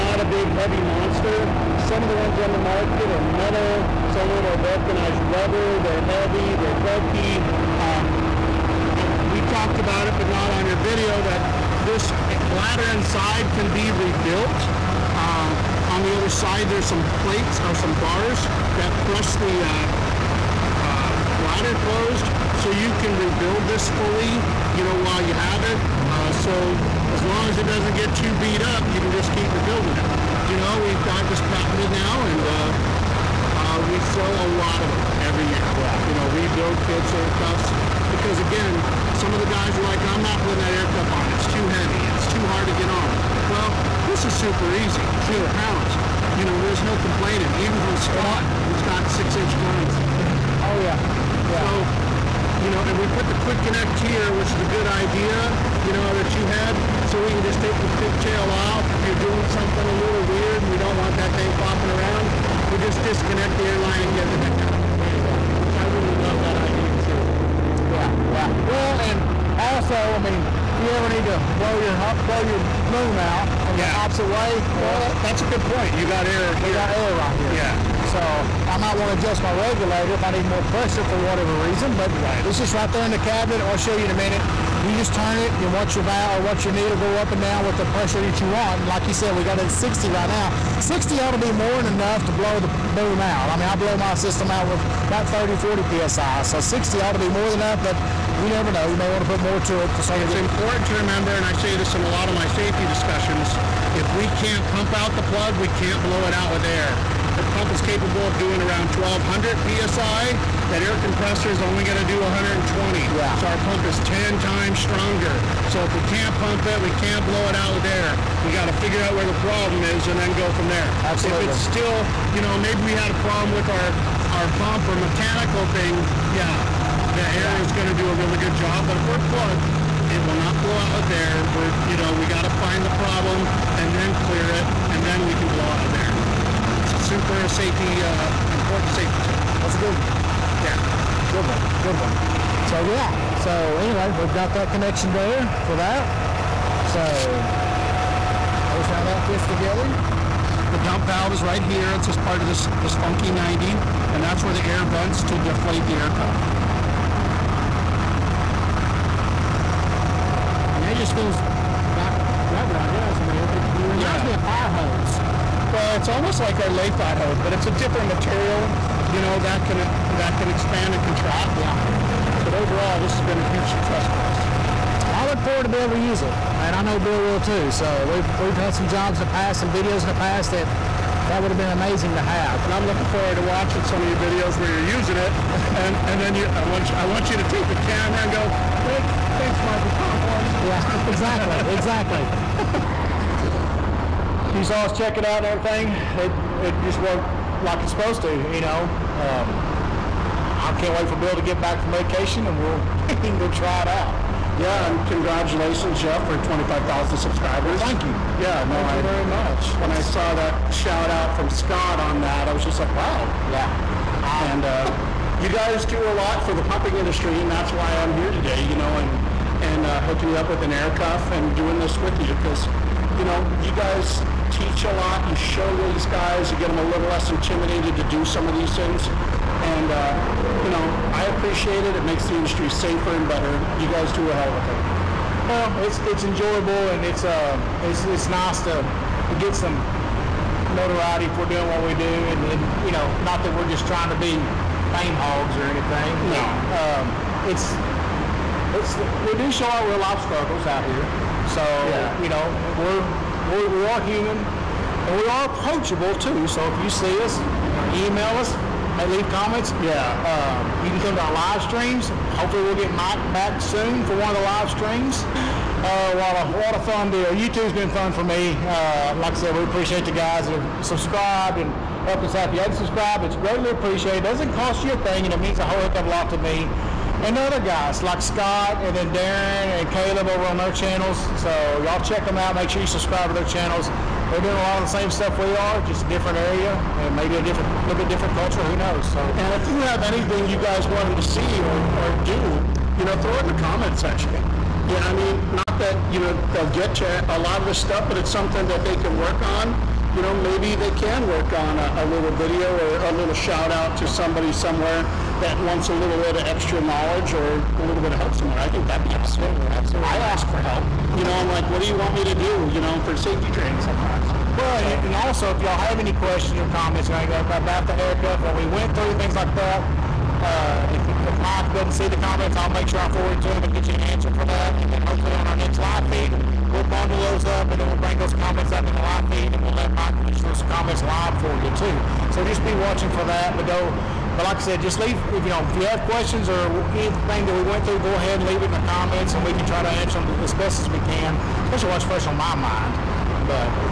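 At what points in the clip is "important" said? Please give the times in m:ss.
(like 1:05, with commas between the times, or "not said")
1:40, 2:18.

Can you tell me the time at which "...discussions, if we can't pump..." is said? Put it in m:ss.
1:42.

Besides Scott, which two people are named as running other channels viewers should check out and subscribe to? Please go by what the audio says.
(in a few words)
Darren and Caleb.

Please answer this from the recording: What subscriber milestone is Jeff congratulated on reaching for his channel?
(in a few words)
25,000.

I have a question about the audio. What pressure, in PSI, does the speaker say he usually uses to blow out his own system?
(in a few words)
30-40 PSI.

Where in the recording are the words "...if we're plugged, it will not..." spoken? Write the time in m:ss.
2:08.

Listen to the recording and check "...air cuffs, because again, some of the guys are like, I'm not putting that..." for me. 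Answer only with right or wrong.
right.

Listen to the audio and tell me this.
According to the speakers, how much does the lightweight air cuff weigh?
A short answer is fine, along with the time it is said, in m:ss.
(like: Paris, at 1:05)
8 pounds, at 0:45.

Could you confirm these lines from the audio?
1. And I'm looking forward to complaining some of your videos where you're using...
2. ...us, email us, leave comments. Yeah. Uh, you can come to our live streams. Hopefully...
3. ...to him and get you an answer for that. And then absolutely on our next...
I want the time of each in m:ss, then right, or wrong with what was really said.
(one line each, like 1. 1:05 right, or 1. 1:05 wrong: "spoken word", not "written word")
1. 3:02 wrong: "watching", not "complaining"
2. 4:17 right
3. 5:23 wrong: "hopefully", not "absolutely".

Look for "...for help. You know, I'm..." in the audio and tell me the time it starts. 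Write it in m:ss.
5:10.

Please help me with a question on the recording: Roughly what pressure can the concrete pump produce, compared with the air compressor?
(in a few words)
1200 psi.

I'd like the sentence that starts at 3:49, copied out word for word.
And, uh, you know, I appreciate it.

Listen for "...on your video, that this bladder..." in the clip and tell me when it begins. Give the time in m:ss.
0:10.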